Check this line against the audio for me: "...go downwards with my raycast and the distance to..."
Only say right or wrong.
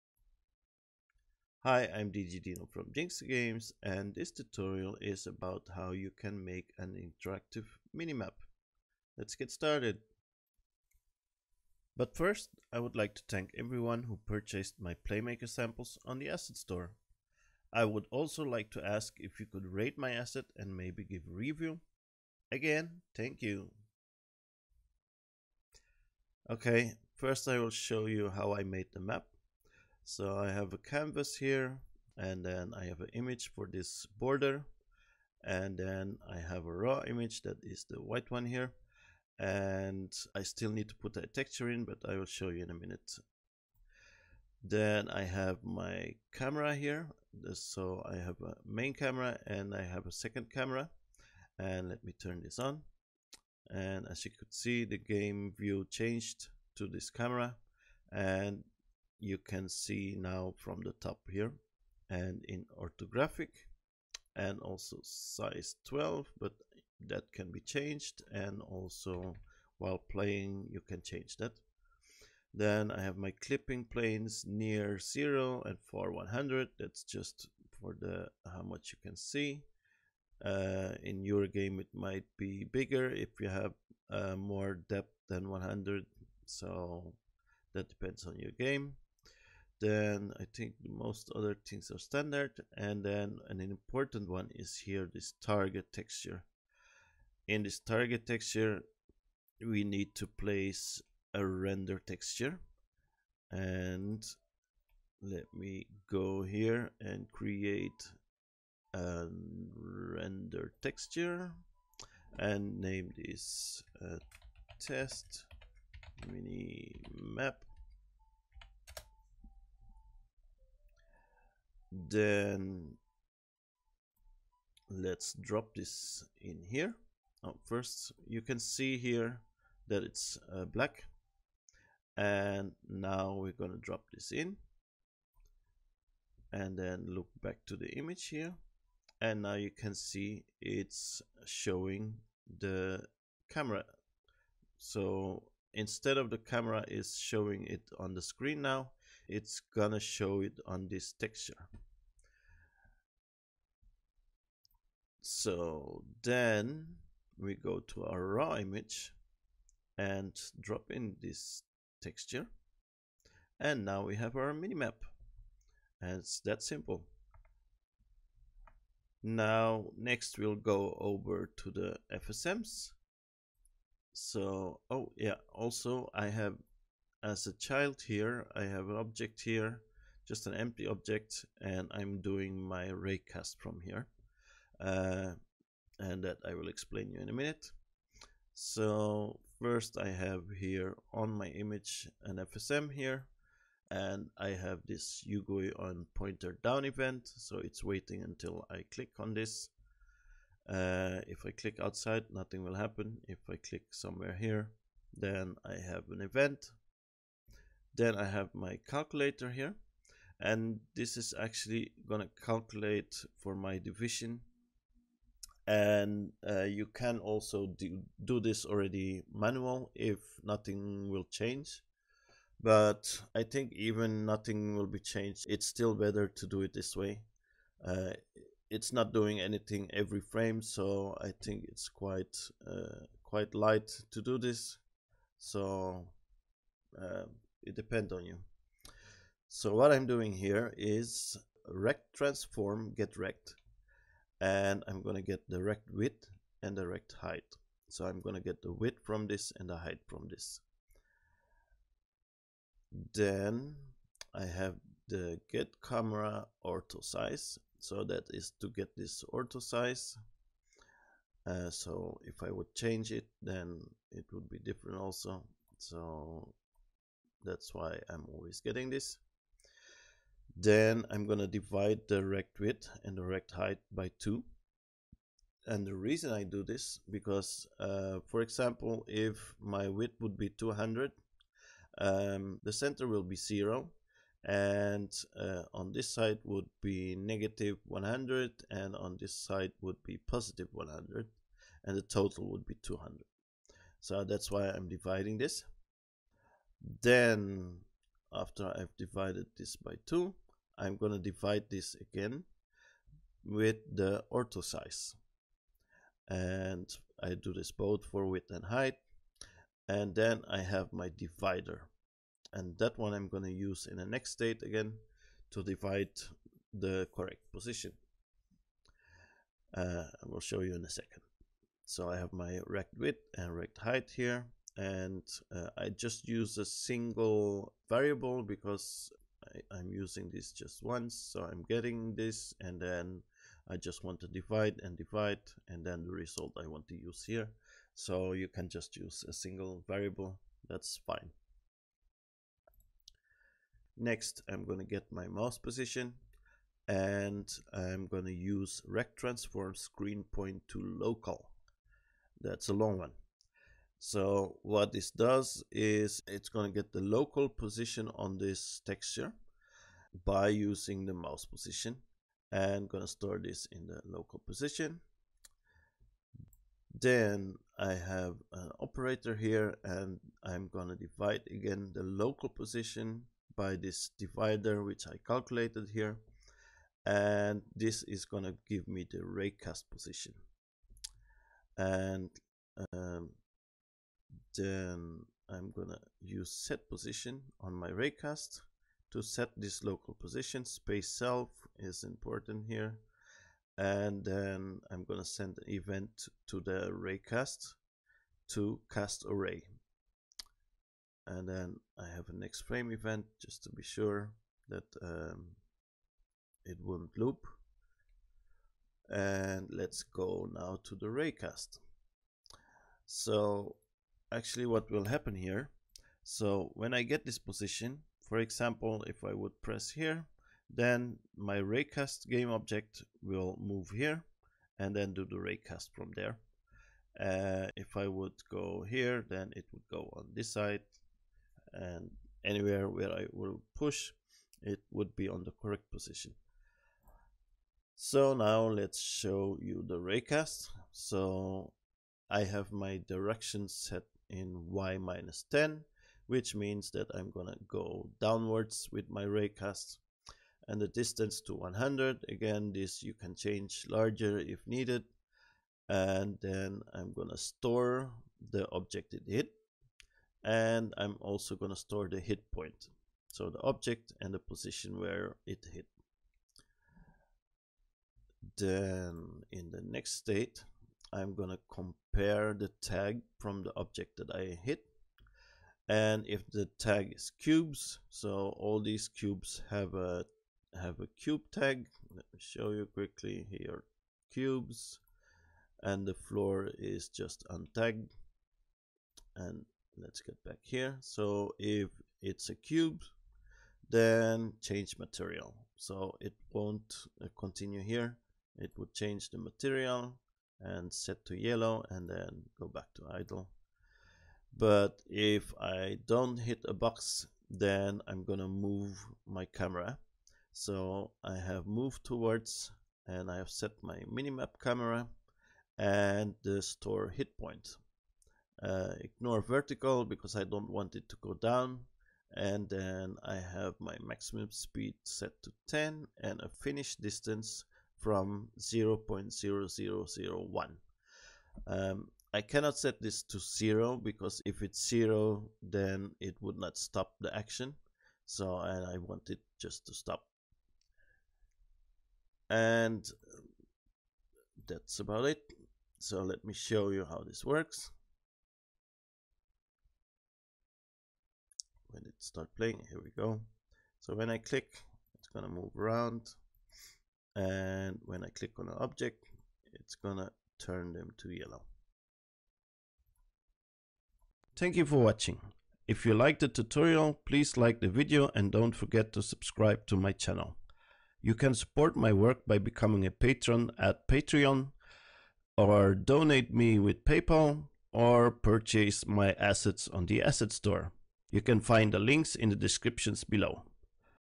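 right.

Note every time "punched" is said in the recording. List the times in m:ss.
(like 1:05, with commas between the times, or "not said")
not said.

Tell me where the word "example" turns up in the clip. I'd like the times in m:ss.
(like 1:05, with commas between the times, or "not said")
4:38, 6:58.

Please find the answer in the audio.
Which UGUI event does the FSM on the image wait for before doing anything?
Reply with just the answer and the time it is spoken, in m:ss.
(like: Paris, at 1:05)
on pointer down, at 3:15.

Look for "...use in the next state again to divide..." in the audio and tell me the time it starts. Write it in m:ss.
5:13.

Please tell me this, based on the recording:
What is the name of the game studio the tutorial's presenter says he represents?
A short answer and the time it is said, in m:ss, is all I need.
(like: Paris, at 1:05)
Jinxter Games, at 0:02.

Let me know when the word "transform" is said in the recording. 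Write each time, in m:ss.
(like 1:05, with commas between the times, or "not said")
4:02, 5:49.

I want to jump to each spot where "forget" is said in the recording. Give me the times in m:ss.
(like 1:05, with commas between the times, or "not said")
9:28.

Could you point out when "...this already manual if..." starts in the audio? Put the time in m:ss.
3:38.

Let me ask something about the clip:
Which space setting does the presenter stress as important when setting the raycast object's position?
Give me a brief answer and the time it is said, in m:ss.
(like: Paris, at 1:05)
self, at 6:30.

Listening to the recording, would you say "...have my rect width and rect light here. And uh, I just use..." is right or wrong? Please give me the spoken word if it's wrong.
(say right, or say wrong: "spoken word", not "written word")
wrong: "height", not "light".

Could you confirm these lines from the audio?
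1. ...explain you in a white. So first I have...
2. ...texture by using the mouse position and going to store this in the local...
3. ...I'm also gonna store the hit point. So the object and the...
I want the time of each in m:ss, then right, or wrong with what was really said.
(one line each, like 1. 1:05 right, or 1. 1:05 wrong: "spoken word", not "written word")
1. 3:06 wrong: "minute", not "white"
2. 5:58 right
3. 7:40 right.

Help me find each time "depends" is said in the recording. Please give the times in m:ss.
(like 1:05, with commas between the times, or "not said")
1:27, 3:57.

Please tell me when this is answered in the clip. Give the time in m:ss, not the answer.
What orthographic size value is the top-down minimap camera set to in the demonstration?
1:05.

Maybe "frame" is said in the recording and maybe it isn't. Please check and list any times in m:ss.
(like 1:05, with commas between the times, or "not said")
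3:50, 6:42.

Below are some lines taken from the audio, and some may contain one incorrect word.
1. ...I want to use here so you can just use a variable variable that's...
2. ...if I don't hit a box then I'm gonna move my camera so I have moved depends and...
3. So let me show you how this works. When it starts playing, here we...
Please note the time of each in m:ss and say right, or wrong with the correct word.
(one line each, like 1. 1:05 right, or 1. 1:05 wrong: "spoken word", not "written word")
1. 5:36 wrong: "single", not "variable"
2. 8:25 wrong: "towards", not "depends"
3. 9:05 right.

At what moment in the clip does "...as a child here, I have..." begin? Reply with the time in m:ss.
2:57.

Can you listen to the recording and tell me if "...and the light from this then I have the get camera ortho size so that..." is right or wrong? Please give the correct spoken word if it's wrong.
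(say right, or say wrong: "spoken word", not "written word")
wrong: "height", not "light".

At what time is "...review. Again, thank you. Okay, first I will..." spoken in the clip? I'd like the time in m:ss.
0:21.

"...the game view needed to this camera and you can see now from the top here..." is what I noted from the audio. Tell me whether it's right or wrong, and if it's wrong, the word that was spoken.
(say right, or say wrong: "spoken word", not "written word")
wrong: "changed", not "needed".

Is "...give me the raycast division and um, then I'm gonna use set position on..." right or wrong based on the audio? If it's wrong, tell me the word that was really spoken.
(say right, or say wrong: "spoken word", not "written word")
wrong: "position", not "division".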